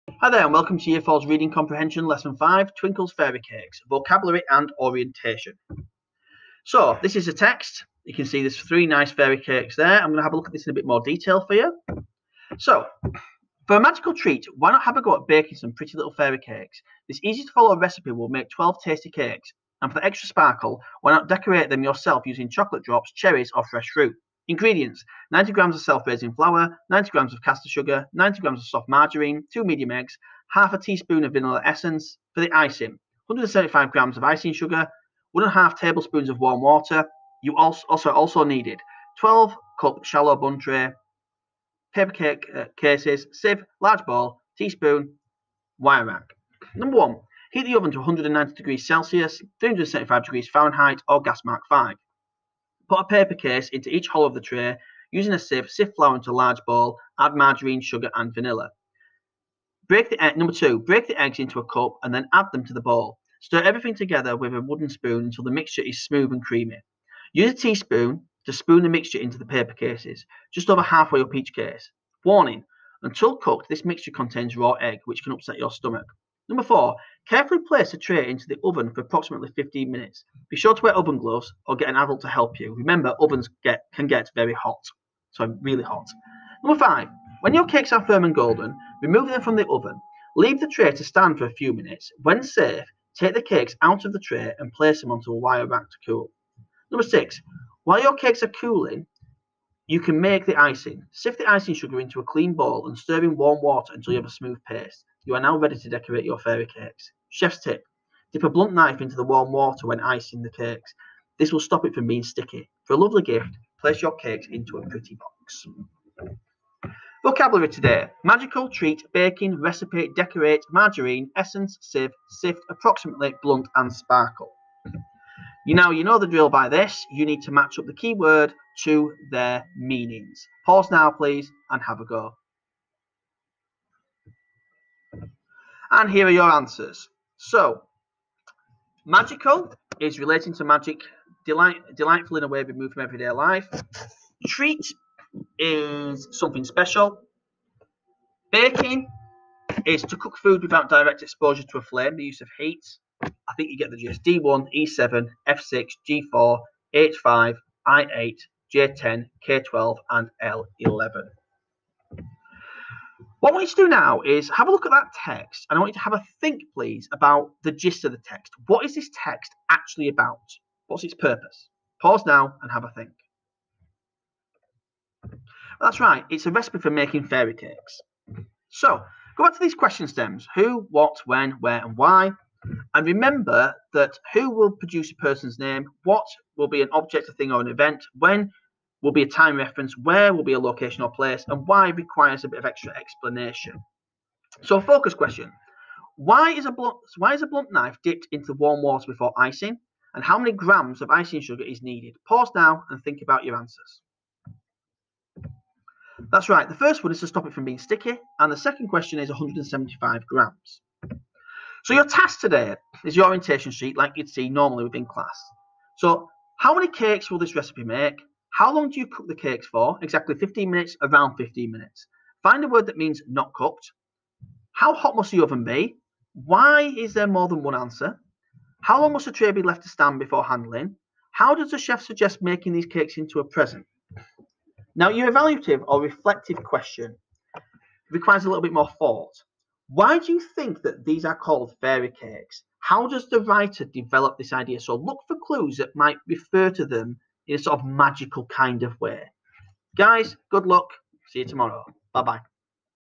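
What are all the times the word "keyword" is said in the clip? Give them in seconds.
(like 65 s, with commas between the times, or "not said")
127 s.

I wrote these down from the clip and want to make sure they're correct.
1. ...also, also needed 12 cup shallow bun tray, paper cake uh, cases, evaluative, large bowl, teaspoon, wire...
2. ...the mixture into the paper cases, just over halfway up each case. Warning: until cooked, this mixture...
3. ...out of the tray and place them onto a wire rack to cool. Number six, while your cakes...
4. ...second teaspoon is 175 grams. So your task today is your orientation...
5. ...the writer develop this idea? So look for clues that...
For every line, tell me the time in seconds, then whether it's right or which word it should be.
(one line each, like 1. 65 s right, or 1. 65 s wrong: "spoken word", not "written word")
1. 37 s wrong: "sieve", not "evaluative"
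2. 68 s right
3. 93 s right
4. 208 s wrong: "question", not "teaspoon"
5. 243 s right.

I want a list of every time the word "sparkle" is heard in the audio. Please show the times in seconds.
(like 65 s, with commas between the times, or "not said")
20 s, 123 s.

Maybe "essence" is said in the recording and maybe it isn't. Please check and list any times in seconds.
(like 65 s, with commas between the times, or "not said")
31 s, 121 s.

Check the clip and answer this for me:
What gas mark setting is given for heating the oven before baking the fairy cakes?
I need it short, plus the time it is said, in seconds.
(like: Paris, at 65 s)
gas mark 5, at 51 s.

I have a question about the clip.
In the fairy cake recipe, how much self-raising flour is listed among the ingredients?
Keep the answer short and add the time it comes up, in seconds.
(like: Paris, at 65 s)
90 grams, at 25 s.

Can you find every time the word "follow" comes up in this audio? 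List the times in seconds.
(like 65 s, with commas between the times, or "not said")
17 s.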